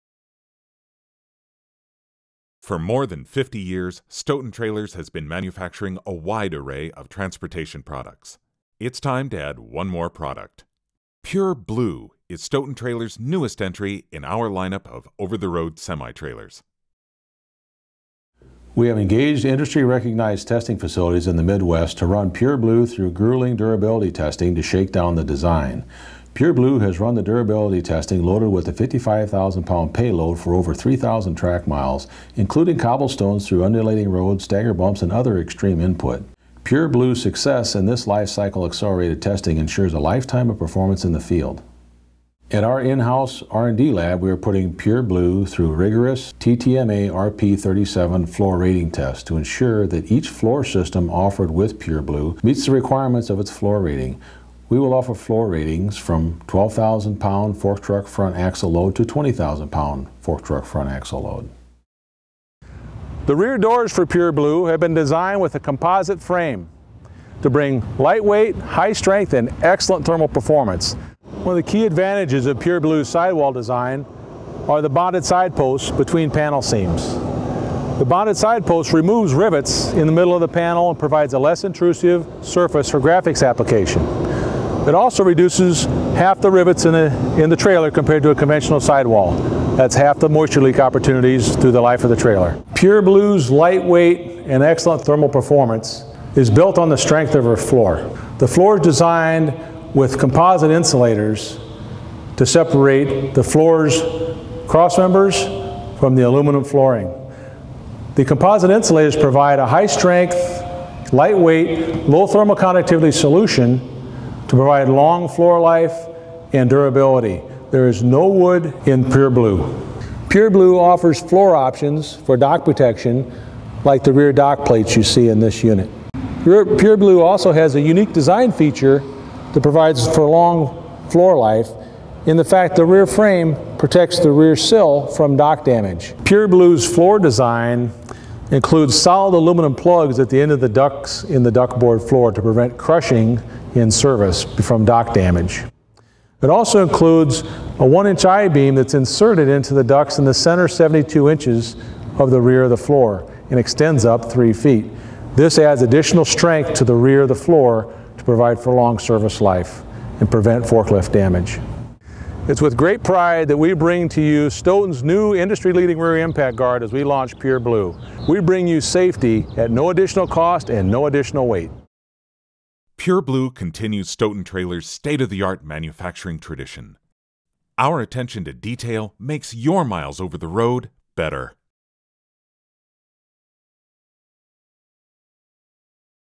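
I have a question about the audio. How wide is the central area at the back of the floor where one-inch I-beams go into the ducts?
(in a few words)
72 inches.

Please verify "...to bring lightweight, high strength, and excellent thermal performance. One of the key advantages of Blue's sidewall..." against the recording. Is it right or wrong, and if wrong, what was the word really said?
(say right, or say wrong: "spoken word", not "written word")
wrong: "PureBlue", not "Blue".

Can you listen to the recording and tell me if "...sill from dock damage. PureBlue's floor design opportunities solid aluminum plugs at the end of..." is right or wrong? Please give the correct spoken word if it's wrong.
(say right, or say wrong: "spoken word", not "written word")
wrong: "includes", not "opportunities".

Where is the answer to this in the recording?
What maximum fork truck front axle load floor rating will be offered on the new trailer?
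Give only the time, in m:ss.
0:59.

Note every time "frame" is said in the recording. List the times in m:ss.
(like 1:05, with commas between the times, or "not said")
1:06, 2:13.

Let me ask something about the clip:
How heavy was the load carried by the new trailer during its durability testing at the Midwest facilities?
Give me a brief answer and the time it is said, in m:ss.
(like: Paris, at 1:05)
55,000 pounds, at 0:28.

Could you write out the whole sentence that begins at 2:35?
This adds additional strength to the rear of the floor to provide for long service life and prevent forklift damage.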